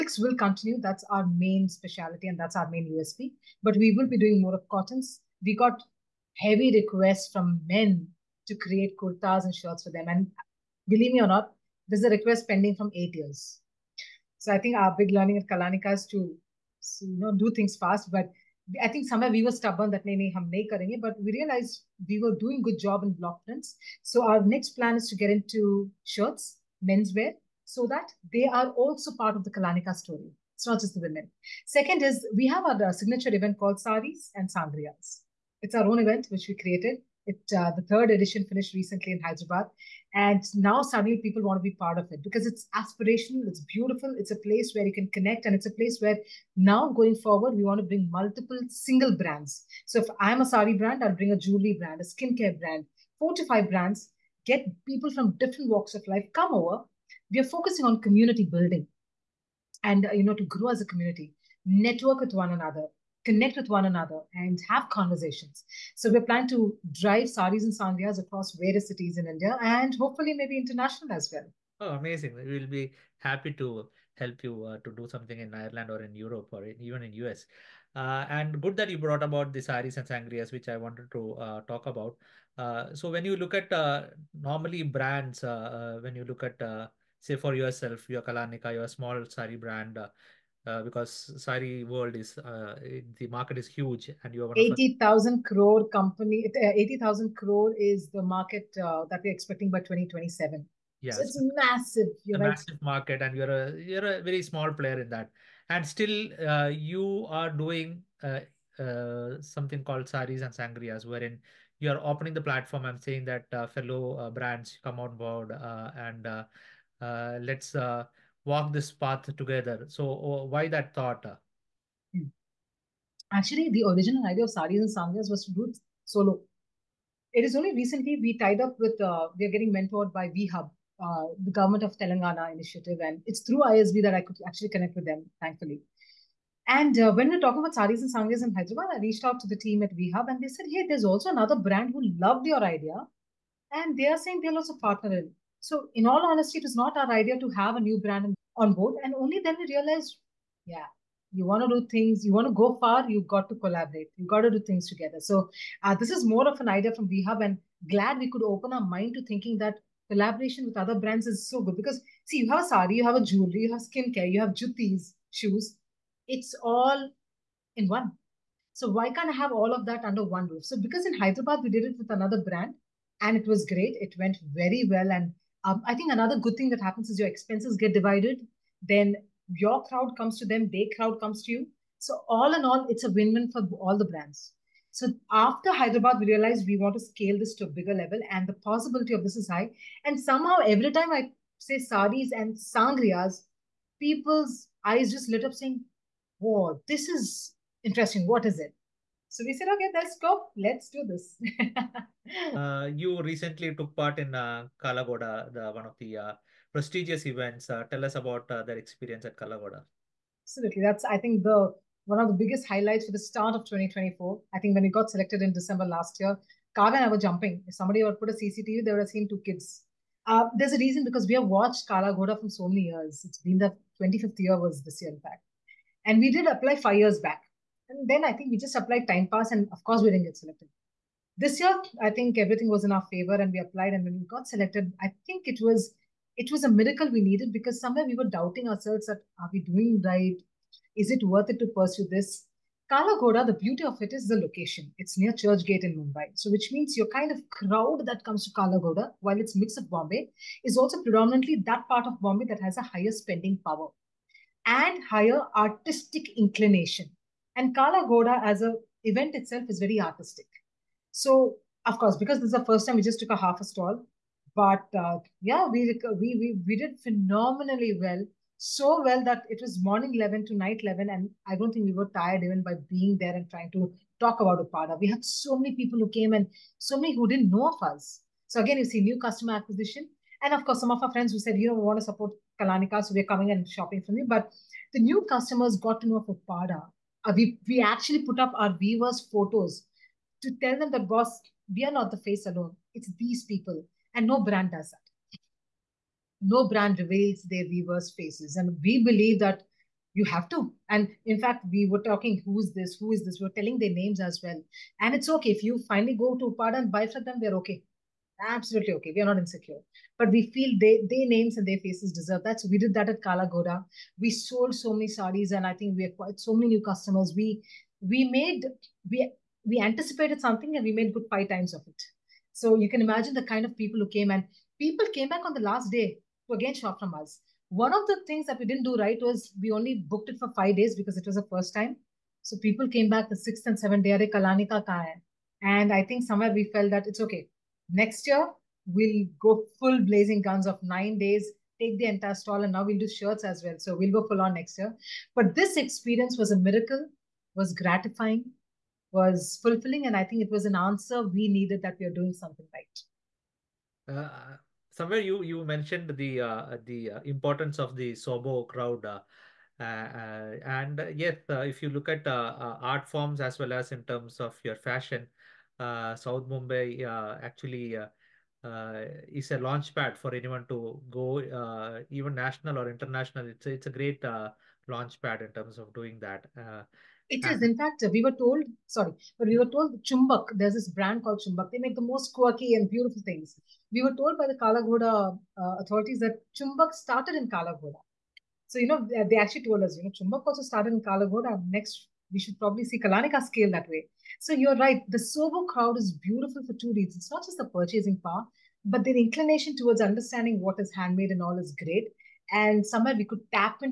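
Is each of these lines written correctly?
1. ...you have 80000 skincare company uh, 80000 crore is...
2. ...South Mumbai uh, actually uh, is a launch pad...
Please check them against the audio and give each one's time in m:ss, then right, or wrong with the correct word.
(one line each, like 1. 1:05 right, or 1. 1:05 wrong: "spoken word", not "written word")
1. 1:34 wrong: "crore", not "skincare"
2. 6:06 right.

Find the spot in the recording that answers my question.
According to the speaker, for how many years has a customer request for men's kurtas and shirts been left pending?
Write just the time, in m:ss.
0:12.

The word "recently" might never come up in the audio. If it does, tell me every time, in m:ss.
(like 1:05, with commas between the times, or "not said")
0:38, 2:07, 3:23.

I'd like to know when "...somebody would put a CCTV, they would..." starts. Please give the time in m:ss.
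3:37.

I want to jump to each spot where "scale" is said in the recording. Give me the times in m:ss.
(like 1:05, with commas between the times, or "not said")
3:07, 6:33.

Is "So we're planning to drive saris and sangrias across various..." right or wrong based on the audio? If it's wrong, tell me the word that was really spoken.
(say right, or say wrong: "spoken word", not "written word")
right.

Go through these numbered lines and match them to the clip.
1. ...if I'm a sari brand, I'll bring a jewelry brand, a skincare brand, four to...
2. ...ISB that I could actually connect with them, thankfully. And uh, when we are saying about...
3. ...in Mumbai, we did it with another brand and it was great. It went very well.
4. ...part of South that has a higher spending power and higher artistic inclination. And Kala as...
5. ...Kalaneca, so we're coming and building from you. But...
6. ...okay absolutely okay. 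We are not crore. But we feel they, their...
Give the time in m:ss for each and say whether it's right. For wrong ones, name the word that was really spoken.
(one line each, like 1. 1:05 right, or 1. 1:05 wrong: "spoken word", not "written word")
1. 0:50 right
2. 2:13 wrong: "talking", not "saying"
3. 2:51 wrong: "Hyderabad", not "Mumbai"
4. 4:11 wrong: "Bombay", not "South"
5. 4:42 wrong: "shopping", not "building"
6. 5:07 wrong: "insecure", not "crore".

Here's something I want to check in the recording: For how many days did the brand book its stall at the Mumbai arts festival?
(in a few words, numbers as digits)
5 days.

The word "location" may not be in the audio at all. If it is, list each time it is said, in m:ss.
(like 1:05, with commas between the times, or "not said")
4:04.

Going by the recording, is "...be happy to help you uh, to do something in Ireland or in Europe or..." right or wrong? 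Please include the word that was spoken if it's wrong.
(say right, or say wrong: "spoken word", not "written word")
right.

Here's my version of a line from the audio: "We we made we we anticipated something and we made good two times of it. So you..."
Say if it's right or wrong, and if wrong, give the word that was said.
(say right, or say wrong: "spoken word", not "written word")
wrong: "five", not "two".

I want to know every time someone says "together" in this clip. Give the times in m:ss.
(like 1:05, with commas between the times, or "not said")
1:59, 2:34.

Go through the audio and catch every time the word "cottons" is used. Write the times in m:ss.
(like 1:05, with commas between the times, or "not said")
0:04.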